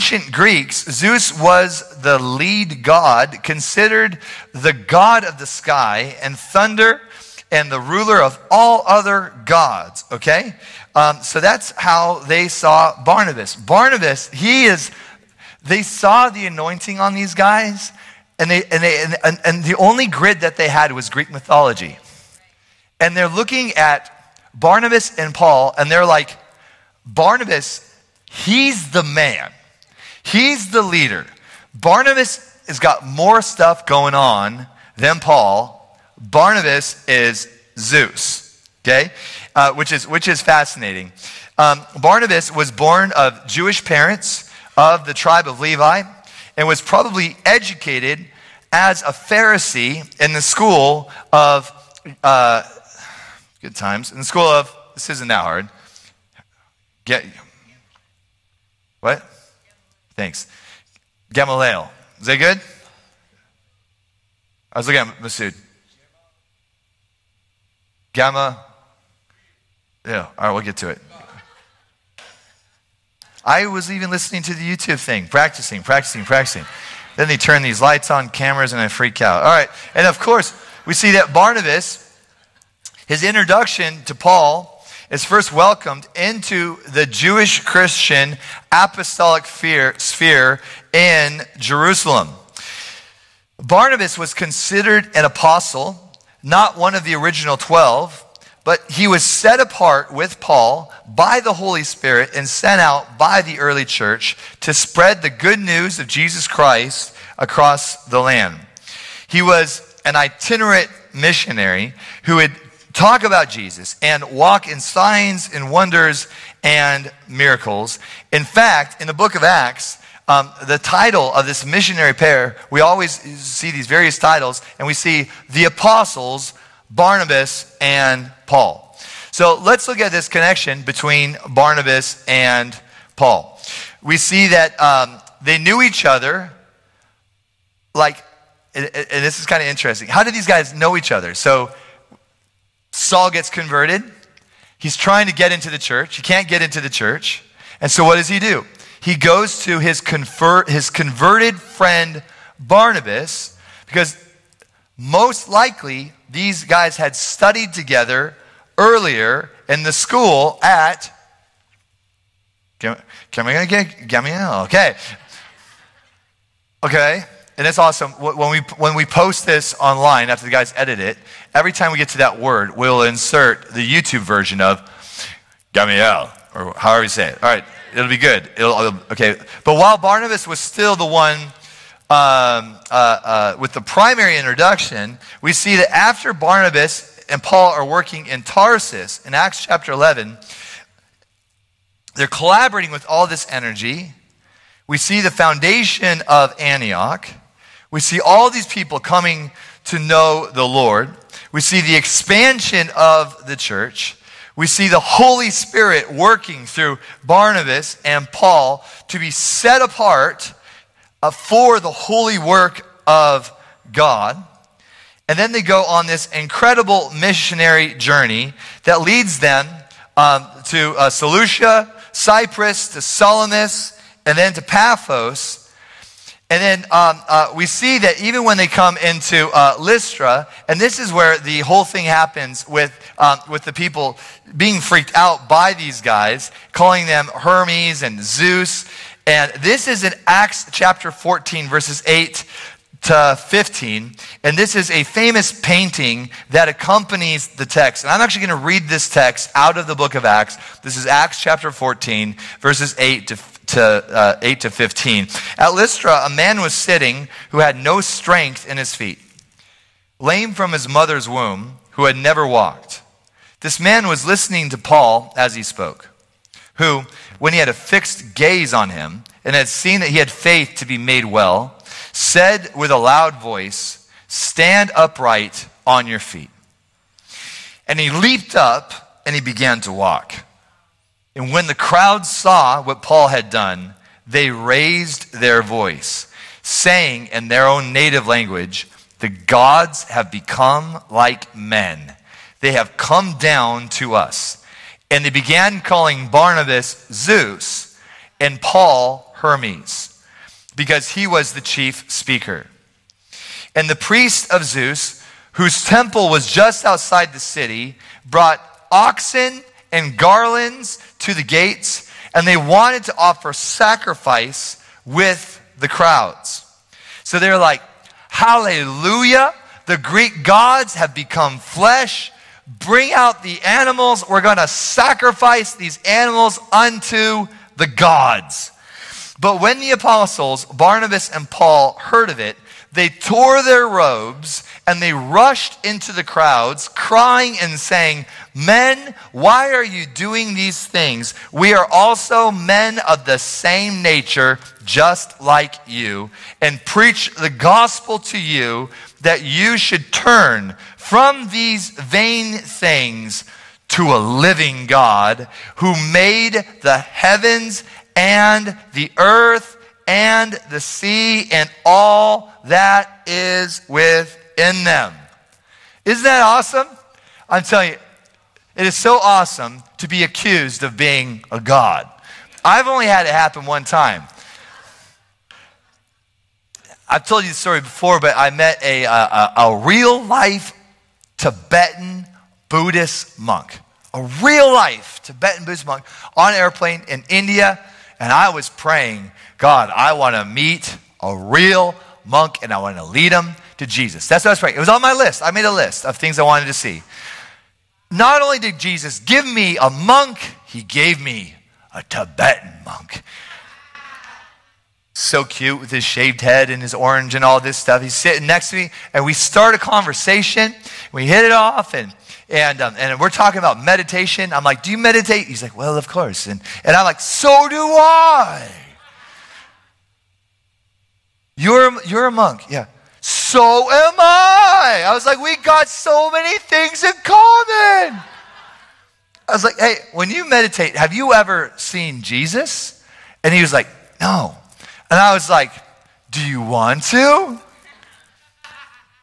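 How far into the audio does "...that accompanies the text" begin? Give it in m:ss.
4:06.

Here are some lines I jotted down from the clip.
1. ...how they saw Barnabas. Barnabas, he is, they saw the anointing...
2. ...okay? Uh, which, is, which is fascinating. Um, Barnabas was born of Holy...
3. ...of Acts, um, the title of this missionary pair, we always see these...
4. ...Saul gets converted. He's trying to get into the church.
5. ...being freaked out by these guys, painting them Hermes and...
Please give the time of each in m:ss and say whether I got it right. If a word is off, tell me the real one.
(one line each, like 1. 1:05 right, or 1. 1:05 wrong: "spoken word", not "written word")
1. 0:11 right
2. 0:38 wrong: "Jewish", not "Holy"
3. 1:59 right
4. 2:22 right
5. 3:54 wrong: "calling", not "painting".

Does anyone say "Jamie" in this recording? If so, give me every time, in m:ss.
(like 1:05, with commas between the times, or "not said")
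not said.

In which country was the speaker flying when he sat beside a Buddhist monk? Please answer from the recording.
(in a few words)
India.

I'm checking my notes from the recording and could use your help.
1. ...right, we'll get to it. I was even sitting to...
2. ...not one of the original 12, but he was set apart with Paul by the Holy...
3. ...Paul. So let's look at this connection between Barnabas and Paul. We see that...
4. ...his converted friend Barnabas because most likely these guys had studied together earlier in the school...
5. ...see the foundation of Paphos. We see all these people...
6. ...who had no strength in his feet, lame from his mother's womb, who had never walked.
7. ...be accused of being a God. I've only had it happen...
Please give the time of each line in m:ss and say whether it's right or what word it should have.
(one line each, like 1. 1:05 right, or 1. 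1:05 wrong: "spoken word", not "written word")
1. 1:10 wrong: "listening", not "sitting"
2. 1:36 right
3. 2:08 right
4. 2:30 right
5. 3:14 wrong: "Antioch", not "Paphos"
6. 4:17 right
7. 6:10 right.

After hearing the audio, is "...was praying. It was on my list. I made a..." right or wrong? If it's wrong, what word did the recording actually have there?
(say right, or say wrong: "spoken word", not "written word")
right.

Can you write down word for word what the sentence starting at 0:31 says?
Barnabas has got more stuff going on than Paul.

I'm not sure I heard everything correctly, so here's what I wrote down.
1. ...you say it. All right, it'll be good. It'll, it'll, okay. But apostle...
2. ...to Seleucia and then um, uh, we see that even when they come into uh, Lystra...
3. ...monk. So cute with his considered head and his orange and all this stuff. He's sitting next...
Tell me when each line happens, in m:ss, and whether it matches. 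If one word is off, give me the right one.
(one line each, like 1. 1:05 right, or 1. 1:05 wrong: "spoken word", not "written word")
1. 2:57 wrong: "while", not "apostle"
2. 3:44 wrong: "Paphos", not "Seleucia"
3. 6:42 wrong: "shaved", not "considered".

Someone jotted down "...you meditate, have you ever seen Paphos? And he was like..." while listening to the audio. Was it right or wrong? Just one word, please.
wrong.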